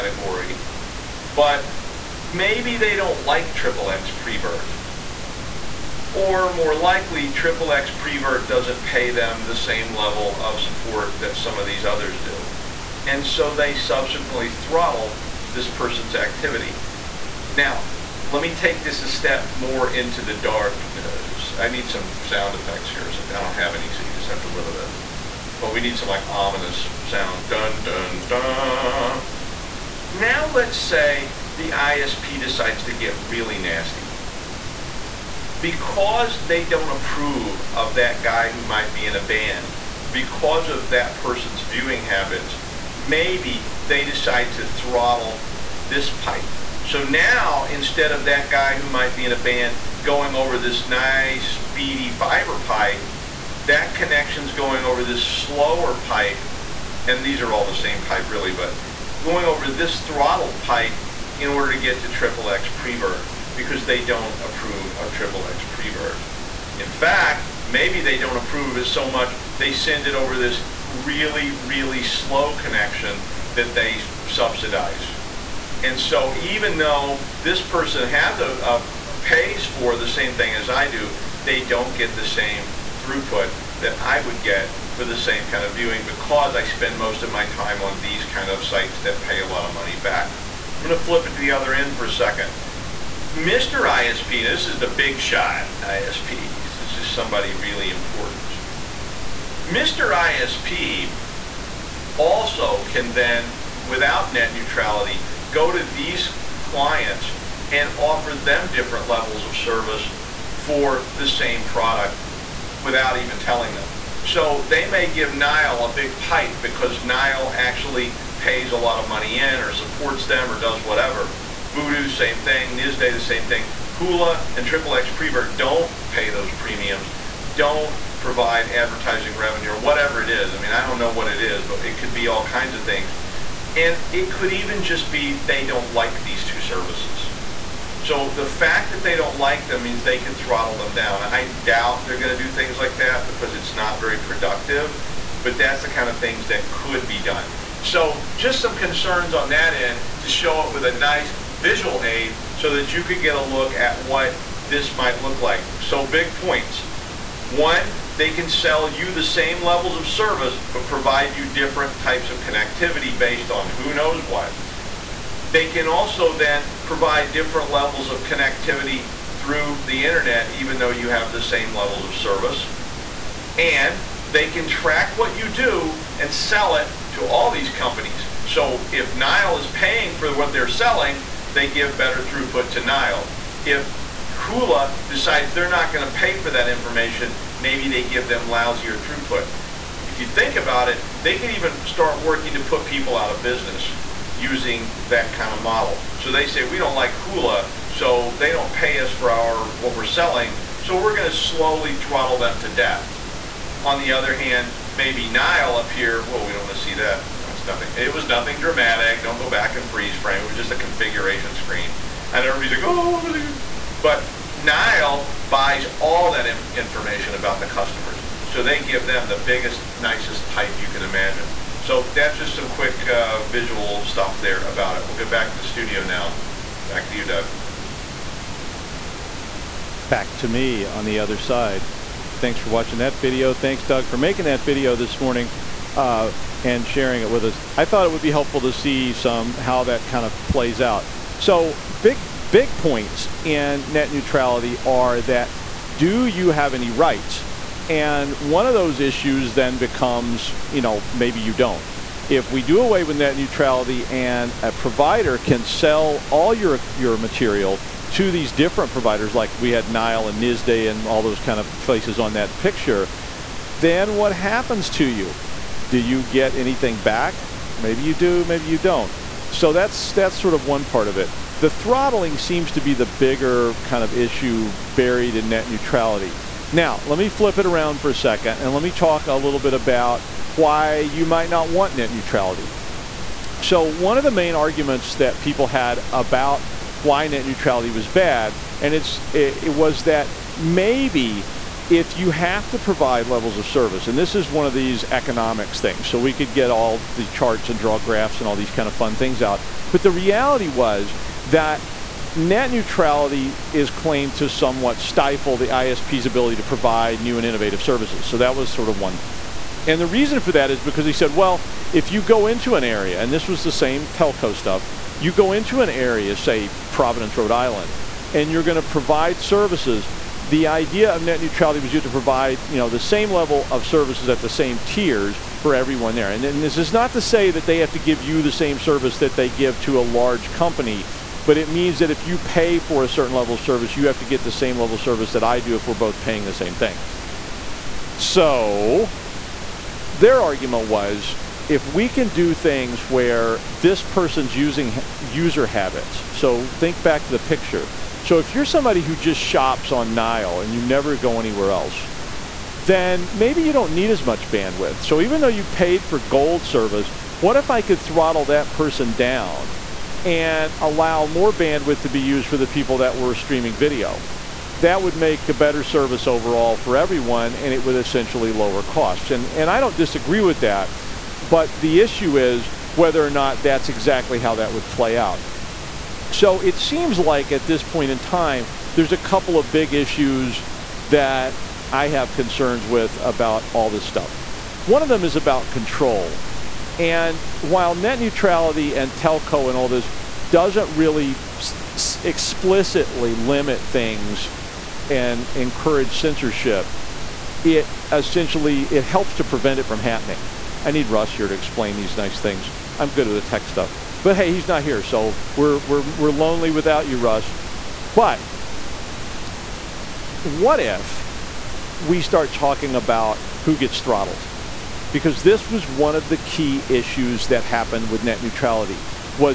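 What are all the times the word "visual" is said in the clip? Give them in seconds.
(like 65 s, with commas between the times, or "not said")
151 s, 223 s.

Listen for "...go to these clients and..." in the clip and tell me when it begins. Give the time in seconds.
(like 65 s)
105 s.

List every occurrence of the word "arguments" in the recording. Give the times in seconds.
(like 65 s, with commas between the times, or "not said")
284 s, 340 s.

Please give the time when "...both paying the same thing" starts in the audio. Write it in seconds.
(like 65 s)
335 s.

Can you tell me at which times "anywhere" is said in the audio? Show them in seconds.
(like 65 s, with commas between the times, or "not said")
351 s.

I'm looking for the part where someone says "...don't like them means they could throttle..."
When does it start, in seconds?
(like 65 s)
139 s.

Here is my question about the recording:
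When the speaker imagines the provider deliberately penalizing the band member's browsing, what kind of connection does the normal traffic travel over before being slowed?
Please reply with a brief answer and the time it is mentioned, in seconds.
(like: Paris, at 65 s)
fiber, at 52 s.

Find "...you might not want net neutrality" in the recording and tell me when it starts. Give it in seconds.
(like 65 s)
280 s.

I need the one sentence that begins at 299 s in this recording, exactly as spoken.
But the reality was that net neutrality is claimed to somewhat stifle the ISP's ability to provide new and innovative services.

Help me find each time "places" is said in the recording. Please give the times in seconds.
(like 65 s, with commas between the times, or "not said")
261 s.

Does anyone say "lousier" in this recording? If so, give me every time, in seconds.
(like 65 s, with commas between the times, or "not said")
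188 s.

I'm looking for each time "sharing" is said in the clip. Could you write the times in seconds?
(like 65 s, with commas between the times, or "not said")
236 s.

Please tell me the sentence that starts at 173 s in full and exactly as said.
And they can track what you do and sell it to all these companies.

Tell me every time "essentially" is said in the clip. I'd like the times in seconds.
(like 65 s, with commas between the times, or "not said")
367 s, 398 s.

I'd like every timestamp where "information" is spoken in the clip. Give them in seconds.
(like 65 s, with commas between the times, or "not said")
186 s, 216 s.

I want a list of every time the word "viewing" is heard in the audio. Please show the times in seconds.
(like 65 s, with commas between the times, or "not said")
41 s, 85 s.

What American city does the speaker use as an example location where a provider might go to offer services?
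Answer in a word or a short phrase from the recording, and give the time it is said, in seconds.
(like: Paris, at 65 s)
Providence, Rhode Island, at 316 s.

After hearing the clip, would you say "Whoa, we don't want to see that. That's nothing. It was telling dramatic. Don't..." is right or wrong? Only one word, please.
wrong.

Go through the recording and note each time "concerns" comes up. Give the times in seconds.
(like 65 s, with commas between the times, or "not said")
148 s, 382 s.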